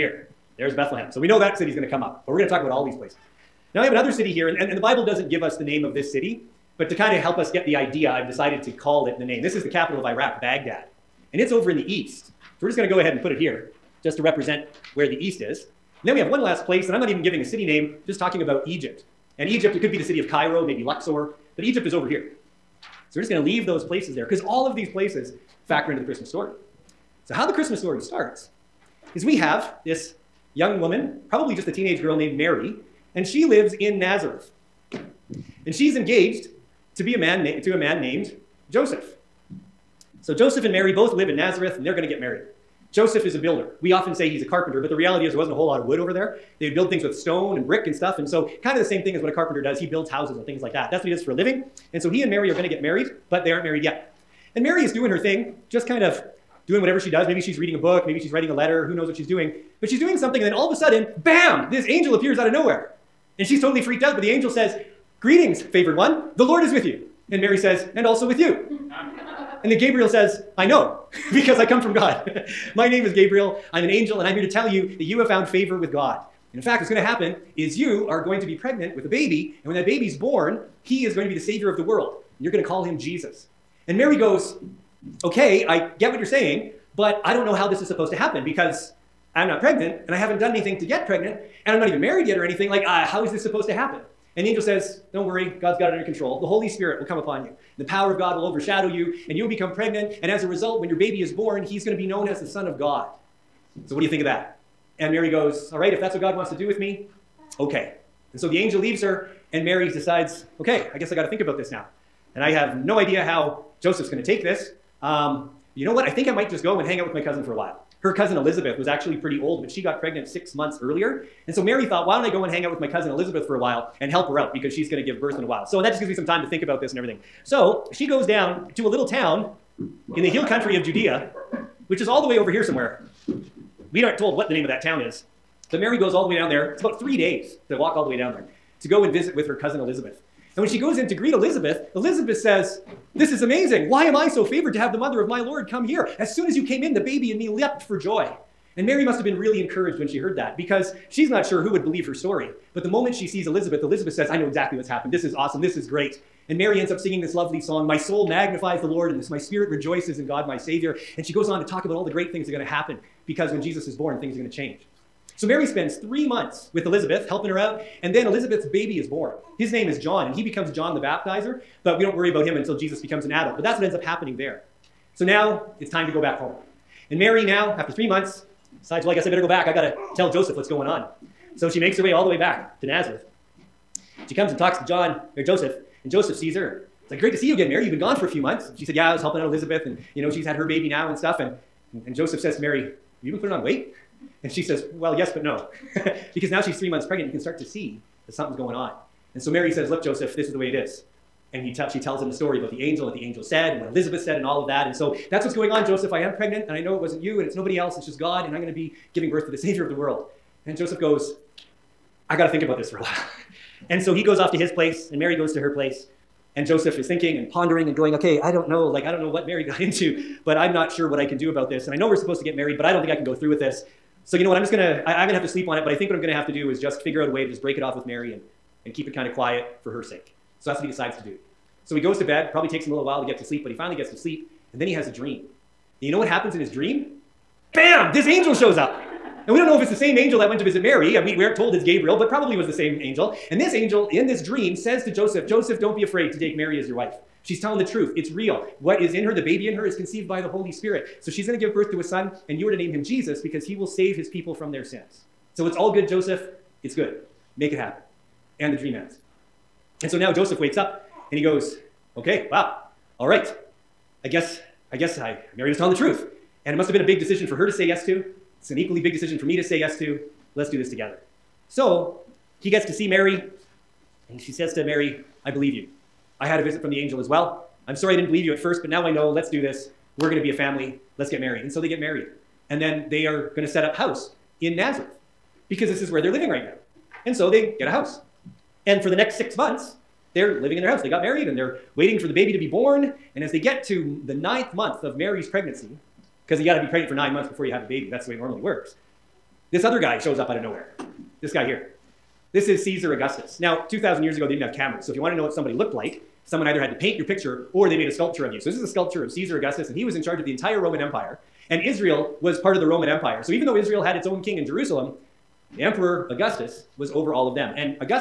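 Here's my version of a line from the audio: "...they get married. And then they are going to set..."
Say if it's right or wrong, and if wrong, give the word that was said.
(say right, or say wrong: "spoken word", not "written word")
right.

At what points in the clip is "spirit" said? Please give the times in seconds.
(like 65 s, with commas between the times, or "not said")
96 s, 159 s, 250 s.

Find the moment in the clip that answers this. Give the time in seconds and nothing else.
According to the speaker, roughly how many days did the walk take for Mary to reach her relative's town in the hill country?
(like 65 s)
136 s.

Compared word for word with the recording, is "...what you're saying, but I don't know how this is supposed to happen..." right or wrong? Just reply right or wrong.
right.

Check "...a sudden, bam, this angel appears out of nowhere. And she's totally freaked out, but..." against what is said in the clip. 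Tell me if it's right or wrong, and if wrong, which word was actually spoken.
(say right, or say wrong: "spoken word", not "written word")
right.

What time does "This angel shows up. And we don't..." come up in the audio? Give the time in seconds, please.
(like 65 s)
238 s.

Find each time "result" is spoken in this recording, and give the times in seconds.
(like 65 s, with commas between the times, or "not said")
100 s.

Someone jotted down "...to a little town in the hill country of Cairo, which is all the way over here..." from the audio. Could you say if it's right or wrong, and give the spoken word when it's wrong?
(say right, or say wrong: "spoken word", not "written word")
wrong: "Judea", not "Cairo".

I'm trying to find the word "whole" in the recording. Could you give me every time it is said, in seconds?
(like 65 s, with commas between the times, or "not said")
45 s.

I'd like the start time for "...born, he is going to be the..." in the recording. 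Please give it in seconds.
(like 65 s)
80 s.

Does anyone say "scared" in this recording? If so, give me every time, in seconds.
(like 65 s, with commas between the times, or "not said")
not said.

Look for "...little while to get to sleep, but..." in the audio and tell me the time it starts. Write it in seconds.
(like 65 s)
232 s.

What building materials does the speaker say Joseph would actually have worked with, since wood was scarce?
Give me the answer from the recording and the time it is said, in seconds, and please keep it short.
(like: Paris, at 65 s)
stone and brick, at 47 s.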